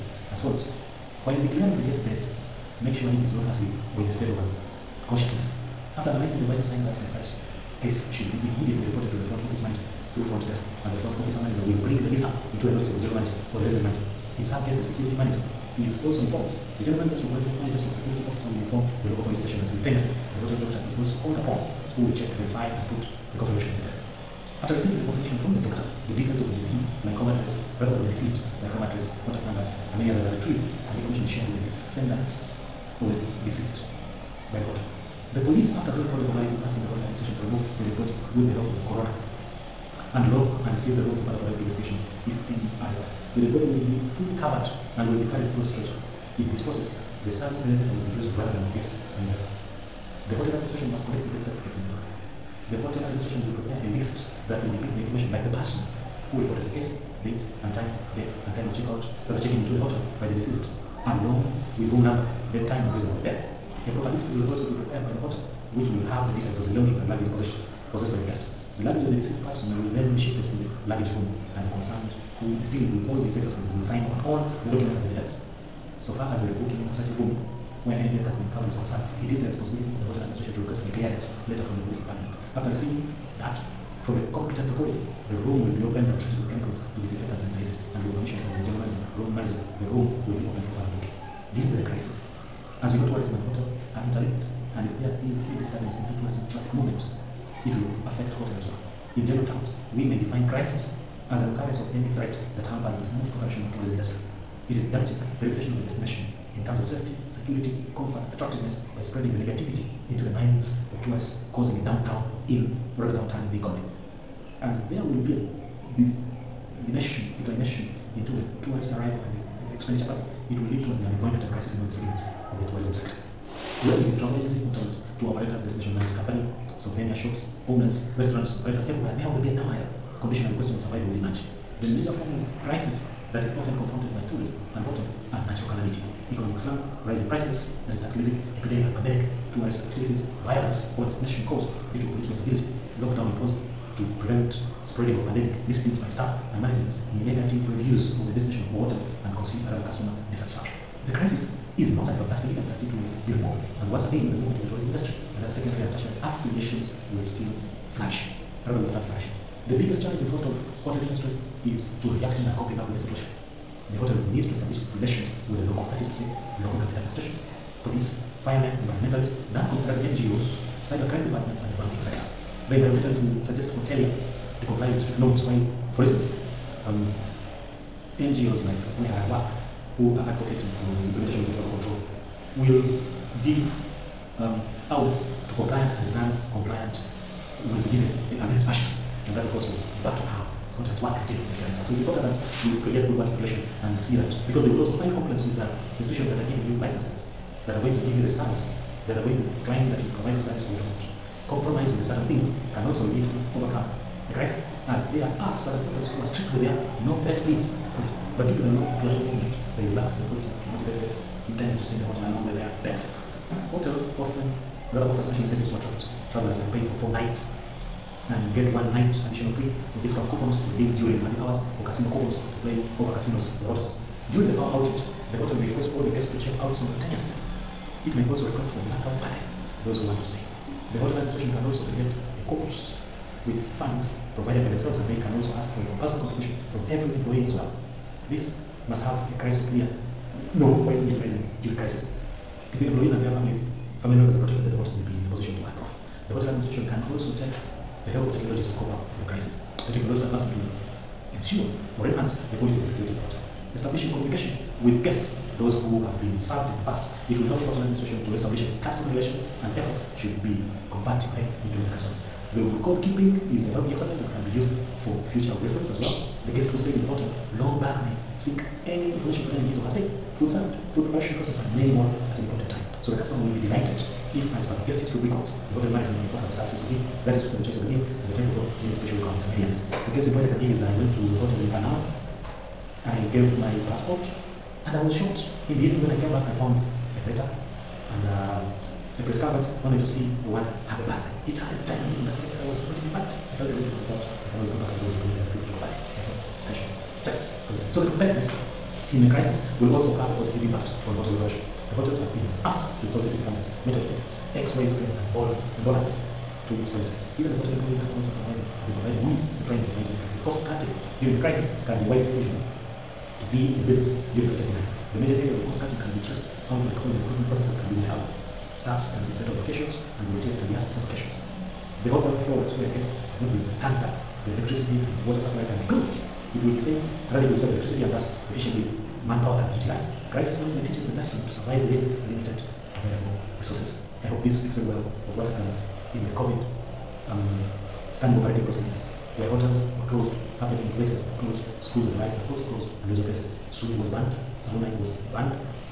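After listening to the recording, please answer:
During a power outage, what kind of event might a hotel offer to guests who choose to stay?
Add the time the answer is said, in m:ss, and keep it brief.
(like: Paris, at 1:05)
Blackout party, at 3:48.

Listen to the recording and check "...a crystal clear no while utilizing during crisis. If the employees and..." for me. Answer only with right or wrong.
right.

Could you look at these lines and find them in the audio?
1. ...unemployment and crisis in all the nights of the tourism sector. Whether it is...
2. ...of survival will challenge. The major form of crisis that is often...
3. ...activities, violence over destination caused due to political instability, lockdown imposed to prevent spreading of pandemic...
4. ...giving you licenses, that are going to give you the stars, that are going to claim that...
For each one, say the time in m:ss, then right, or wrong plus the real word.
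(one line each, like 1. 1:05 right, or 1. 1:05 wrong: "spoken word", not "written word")
1. 2:01 wrong: "segments", not "nights"
2. 2:10 wrong: "emerge", not "challenge"
3. 2:19 right
4. 3:16 right.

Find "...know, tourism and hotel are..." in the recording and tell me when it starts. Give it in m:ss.
1:32.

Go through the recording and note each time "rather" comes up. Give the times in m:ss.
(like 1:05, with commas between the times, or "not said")
0:27, 0:48, 1:52, 2:38, 3:34, 5:27.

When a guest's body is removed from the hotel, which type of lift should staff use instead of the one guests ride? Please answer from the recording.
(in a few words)
Service elevator.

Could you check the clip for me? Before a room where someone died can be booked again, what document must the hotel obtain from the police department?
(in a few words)
Clearance letter.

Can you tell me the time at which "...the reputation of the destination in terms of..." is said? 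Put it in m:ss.
1:45.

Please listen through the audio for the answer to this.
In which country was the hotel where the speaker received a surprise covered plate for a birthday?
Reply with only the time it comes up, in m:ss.
4:41.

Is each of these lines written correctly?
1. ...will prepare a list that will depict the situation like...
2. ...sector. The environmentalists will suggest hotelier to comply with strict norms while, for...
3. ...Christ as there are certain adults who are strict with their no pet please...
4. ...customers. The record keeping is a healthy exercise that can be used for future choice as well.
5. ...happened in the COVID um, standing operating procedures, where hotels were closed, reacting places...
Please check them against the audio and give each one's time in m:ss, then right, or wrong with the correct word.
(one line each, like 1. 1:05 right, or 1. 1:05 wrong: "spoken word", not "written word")
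1. 0:53 wrong: "information", not "situation"
2. 2:52 right
3. 3:24 right
4. 4:21 wrong: "reference", not "choice"
5. 5:35 wrong: "happening", not "reacting".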